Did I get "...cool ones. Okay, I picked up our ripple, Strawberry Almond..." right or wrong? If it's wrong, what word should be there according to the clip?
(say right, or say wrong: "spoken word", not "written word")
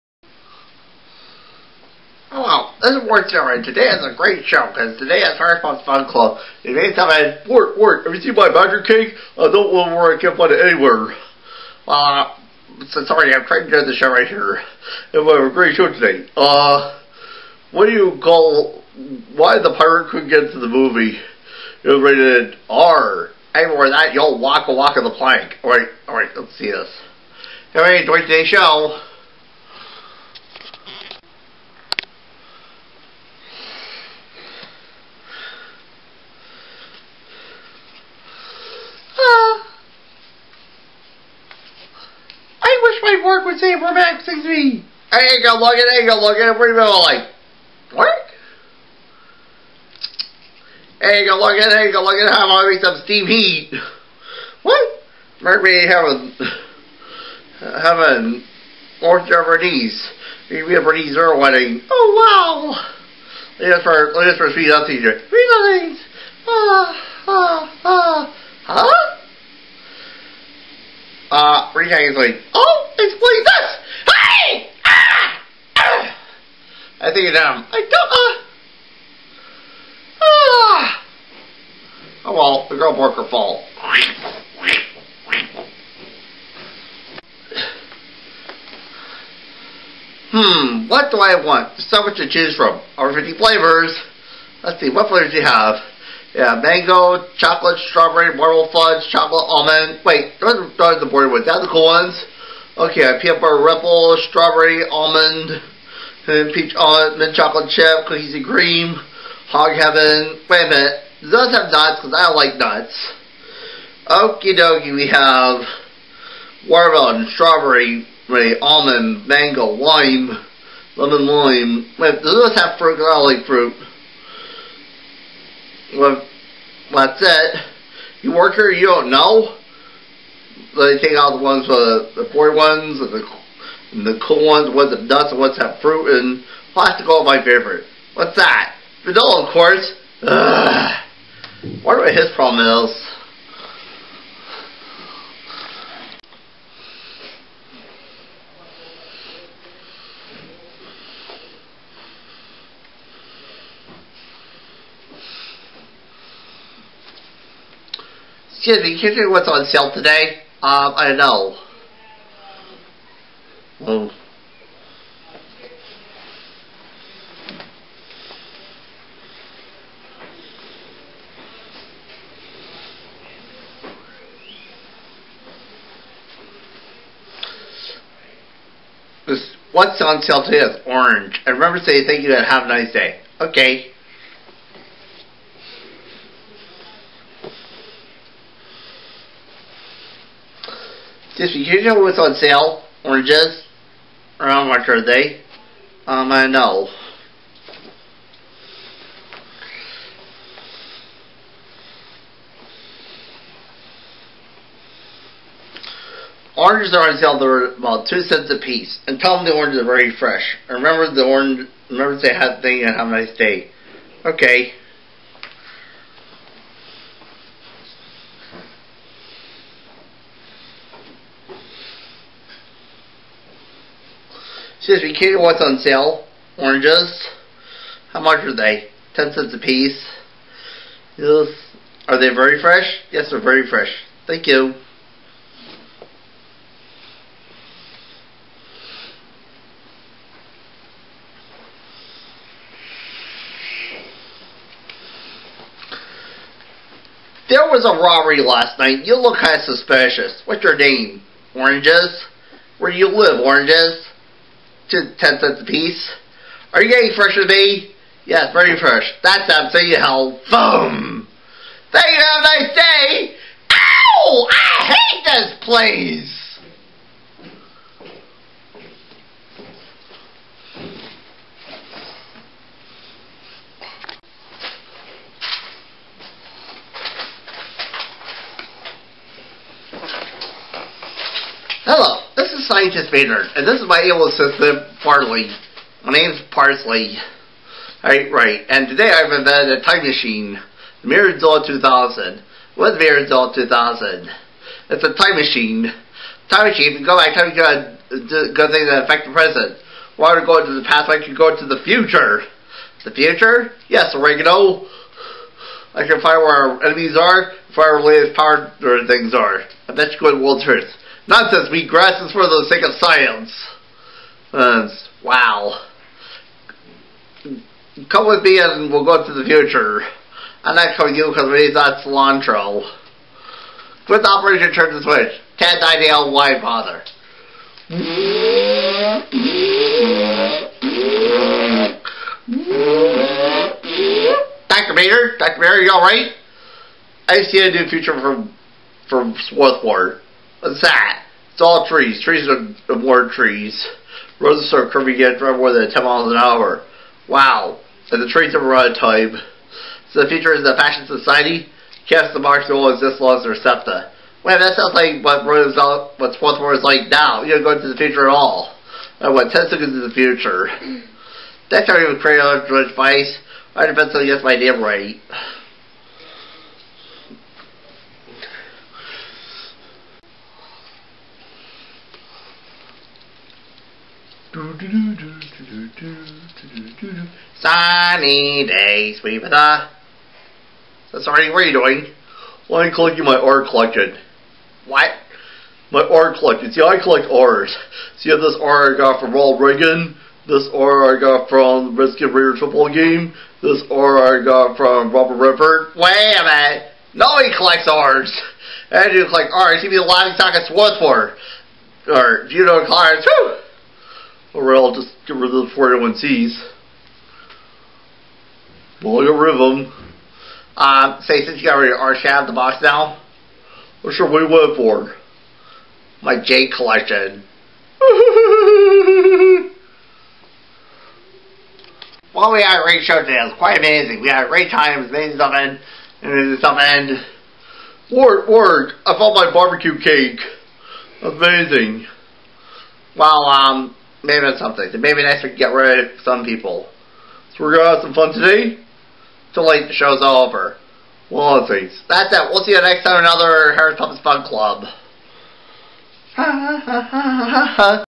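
right.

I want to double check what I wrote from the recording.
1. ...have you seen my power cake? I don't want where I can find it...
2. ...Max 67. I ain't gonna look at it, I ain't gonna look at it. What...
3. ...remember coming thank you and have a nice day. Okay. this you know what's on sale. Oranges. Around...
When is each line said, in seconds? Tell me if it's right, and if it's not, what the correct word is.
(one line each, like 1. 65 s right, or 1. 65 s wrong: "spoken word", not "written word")
1. 8 s wrong: "badger", not "power"
2. 43 s wrong: "63", not "67"
3. 181 s wrong: "saying", not "coming".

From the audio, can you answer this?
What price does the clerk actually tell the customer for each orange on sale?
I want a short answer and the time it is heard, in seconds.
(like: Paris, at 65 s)
Ten cents, at 229 s.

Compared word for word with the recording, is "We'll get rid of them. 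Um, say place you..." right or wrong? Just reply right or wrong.
wrong.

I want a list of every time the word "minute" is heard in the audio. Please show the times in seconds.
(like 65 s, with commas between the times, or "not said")
110 s, 396 s.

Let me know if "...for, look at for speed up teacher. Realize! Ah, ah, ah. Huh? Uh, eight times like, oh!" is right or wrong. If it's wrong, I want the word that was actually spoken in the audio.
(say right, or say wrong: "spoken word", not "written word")
wrong: "three", not "eight".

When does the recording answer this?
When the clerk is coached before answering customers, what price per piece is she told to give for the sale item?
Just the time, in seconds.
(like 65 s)
208 s.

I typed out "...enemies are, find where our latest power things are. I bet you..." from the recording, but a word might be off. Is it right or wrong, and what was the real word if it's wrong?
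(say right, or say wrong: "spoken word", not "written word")
right.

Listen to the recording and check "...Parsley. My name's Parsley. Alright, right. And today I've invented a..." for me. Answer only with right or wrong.
right.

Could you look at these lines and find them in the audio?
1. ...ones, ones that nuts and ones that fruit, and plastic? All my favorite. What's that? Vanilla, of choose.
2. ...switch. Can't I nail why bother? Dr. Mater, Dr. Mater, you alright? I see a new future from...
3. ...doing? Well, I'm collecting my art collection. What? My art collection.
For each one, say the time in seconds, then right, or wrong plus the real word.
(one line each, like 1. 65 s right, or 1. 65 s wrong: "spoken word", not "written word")
1. 134 s wrong: "course", not "choose"
2. 325 s right
3. 381 s right.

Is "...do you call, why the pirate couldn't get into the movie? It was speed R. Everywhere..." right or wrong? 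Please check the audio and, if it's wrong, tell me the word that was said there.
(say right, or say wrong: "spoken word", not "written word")
wrong: "rated", not "speed".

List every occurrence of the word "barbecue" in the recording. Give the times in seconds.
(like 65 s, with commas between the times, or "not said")
429 s.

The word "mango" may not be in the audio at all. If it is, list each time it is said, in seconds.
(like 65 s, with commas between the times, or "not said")
96 s, 119 s.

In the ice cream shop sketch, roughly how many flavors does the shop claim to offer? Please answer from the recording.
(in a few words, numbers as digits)
Over 50.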